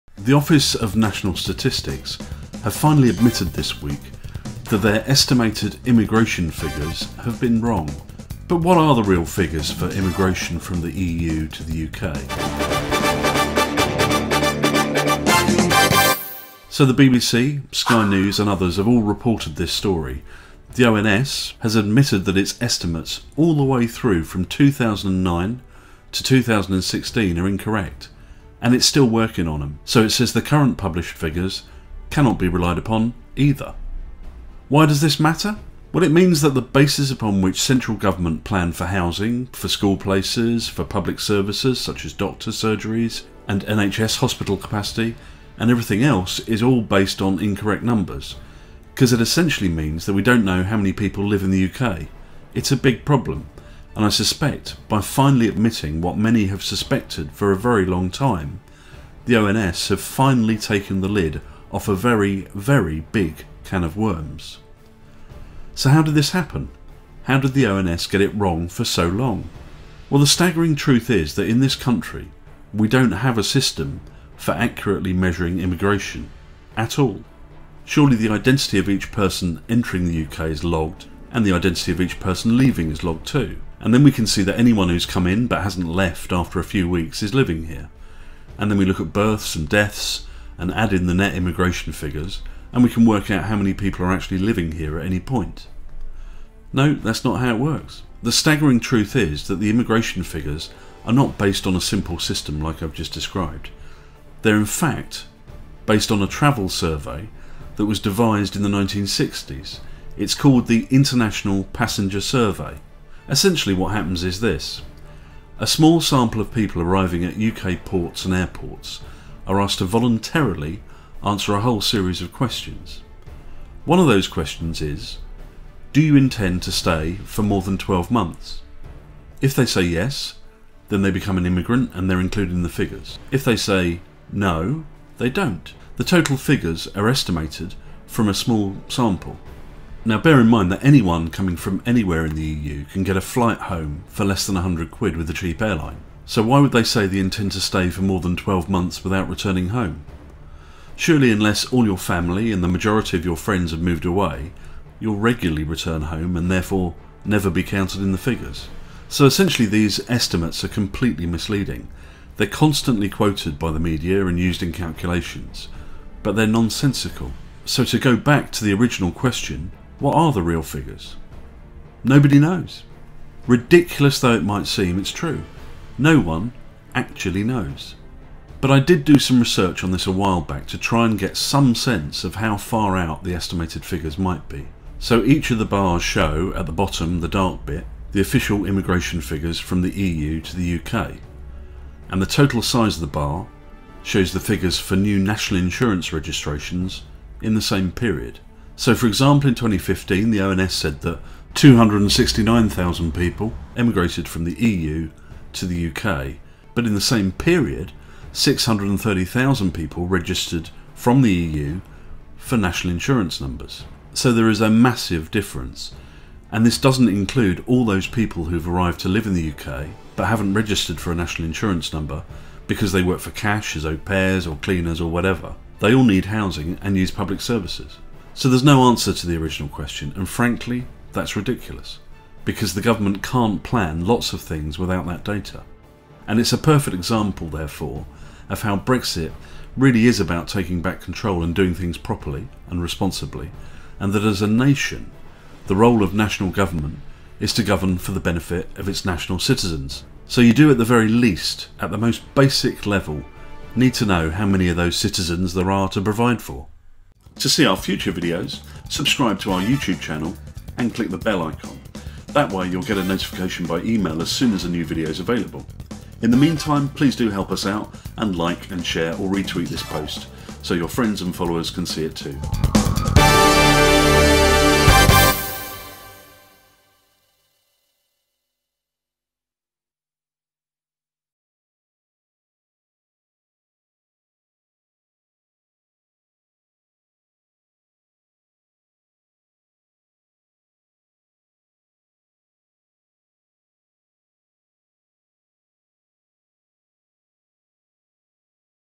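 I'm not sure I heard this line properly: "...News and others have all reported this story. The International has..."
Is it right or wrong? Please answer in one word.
wrong.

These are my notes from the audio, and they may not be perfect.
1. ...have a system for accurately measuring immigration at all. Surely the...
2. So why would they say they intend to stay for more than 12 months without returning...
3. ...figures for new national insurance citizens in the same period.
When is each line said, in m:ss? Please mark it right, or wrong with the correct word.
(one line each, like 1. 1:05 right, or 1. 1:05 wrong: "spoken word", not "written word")
1. 1:13 right
2. 2:26 right
3. 3:14 wrong: "registrations", not "citizens".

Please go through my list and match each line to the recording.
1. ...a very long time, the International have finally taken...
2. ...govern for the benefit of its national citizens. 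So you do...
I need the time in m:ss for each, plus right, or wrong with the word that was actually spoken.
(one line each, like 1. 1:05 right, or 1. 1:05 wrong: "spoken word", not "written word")
1. 0:57 wrong: "ONS", not "International"
2. 4:07 right.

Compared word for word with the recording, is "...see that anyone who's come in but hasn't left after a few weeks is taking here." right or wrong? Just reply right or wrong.
wrong.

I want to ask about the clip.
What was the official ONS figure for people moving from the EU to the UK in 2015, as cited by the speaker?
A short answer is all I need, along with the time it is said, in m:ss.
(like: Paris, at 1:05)
269,000, at 3:21.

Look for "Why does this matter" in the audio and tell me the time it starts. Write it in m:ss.
0:34.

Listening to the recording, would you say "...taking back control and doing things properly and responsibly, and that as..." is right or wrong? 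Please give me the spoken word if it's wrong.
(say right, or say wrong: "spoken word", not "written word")
right.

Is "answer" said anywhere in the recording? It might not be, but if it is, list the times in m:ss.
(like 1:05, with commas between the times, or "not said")
2:01, 3:48.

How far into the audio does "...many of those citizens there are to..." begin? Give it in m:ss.
4:14.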